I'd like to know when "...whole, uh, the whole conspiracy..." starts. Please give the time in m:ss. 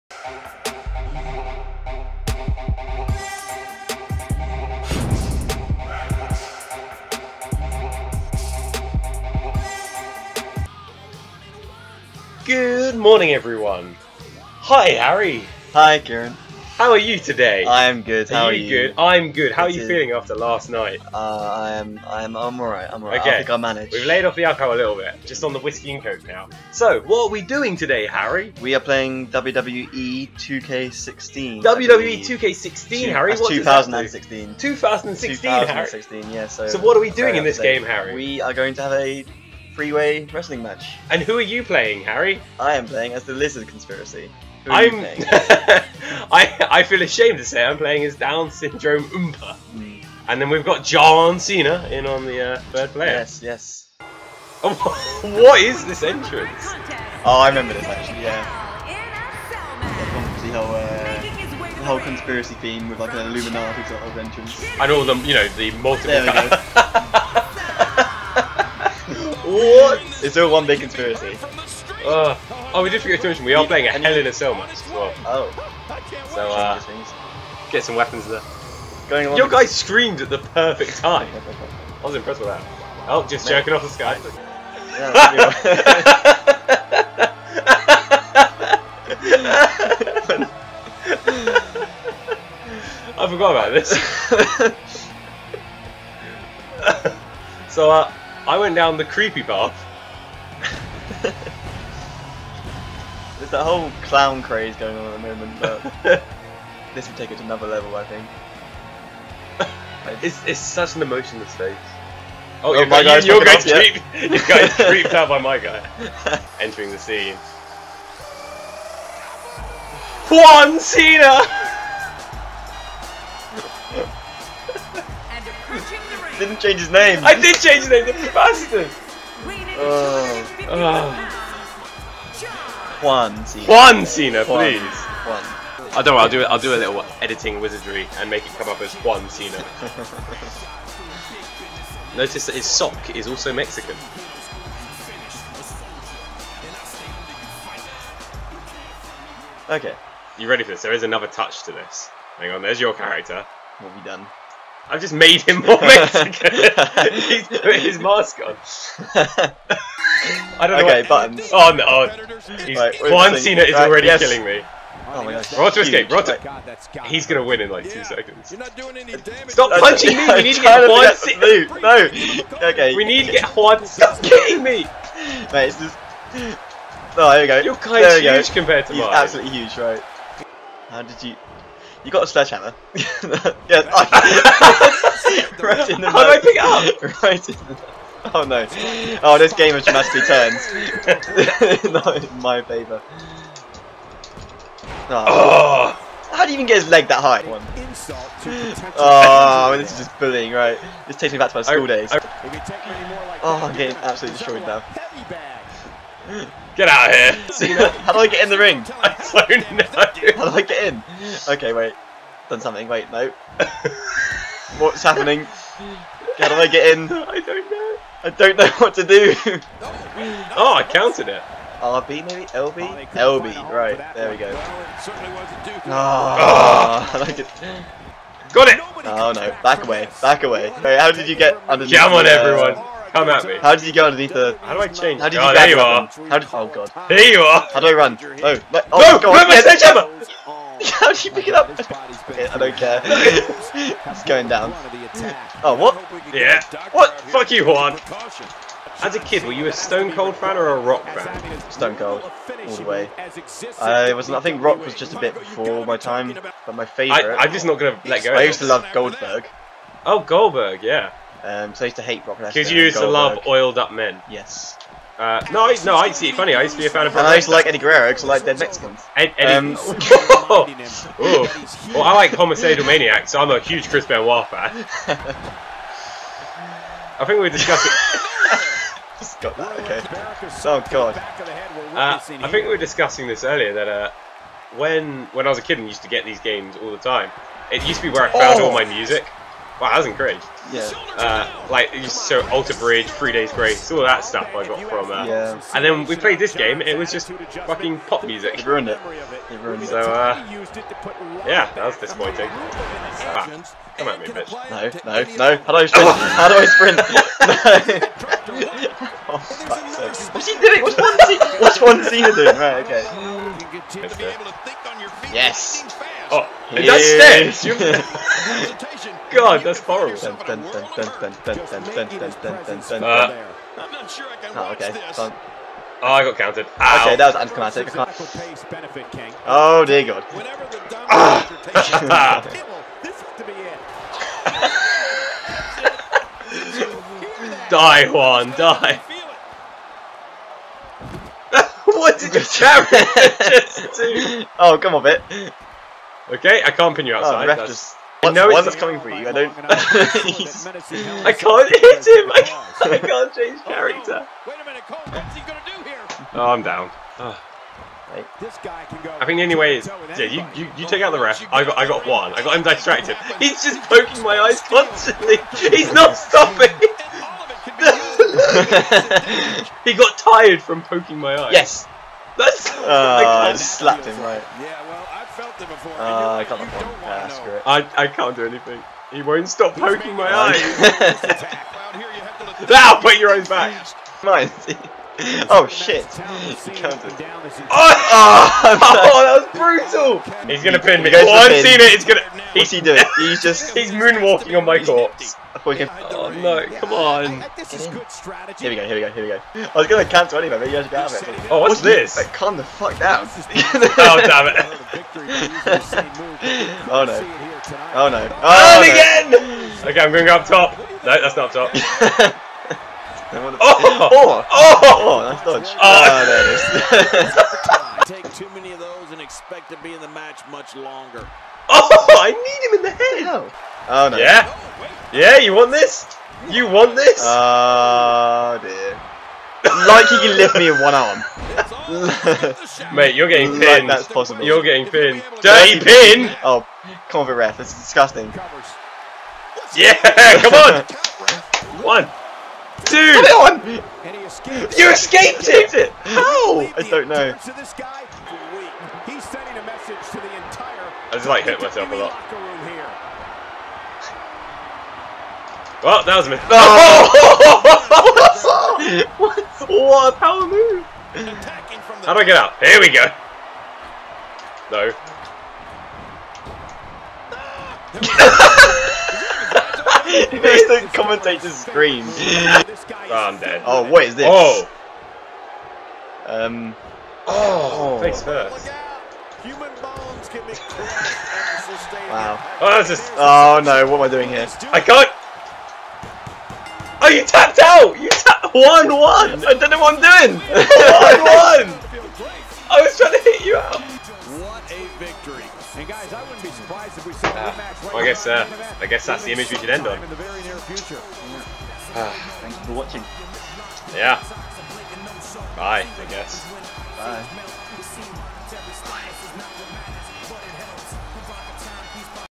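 1:00.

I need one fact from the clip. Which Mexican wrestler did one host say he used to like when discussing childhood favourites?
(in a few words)
Eddie Guerrero.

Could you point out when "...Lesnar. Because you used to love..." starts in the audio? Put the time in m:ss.
4:22.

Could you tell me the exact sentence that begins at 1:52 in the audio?
Oh, oh your, my guy, you, are guy's creep, your guy's creeped out by my guy.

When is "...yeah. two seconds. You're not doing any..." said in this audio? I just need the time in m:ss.
2:47.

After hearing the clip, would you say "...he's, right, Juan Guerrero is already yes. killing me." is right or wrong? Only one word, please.
wrong.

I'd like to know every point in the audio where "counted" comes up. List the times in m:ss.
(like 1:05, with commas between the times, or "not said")
3:40, 5:26.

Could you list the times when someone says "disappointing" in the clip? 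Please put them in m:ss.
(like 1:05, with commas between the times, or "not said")
5:01.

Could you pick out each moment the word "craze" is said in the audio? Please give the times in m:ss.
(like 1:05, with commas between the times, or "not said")
1:44.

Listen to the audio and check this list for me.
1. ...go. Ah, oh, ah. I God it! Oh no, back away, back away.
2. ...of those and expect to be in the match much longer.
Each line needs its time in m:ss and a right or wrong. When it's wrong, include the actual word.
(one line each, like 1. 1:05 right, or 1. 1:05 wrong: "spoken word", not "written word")
1. 3:44 wrong: "Got", not "God"
2. 6:58 right.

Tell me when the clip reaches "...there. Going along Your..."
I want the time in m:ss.
1:18.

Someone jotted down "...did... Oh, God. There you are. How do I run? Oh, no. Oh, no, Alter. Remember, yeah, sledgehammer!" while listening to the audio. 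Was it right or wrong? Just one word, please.
wrong.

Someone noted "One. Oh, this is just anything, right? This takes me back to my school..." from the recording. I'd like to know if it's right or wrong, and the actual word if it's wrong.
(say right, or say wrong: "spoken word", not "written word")
wrong: "bullying", not "anything".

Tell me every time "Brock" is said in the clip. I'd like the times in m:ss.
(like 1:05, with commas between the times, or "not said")
4:22, 4:27.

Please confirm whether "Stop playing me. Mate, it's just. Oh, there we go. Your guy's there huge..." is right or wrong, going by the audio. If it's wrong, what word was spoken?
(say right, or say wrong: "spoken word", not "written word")
wrong: "kidding", not "playing".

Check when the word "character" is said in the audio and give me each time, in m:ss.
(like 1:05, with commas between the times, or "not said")
2:32, 5:53.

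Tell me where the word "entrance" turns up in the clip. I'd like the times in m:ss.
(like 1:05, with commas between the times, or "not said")
0:56, 1:04.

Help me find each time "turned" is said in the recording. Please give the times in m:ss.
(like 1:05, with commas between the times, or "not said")
3:10.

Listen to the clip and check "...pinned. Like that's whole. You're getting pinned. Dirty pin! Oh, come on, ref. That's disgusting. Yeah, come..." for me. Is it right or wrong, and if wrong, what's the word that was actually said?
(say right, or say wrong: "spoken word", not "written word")
wrong: "possible", not "whole".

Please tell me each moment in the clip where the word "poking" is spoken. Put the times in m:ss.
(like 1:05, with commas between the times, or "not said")
6:03, 6:10, 6:19.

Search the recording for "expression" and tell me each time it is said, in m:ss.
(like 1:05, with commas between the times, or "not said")
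not said.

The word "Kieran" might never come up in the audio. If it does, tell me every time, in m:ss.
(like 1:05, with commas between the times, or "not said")
0:15.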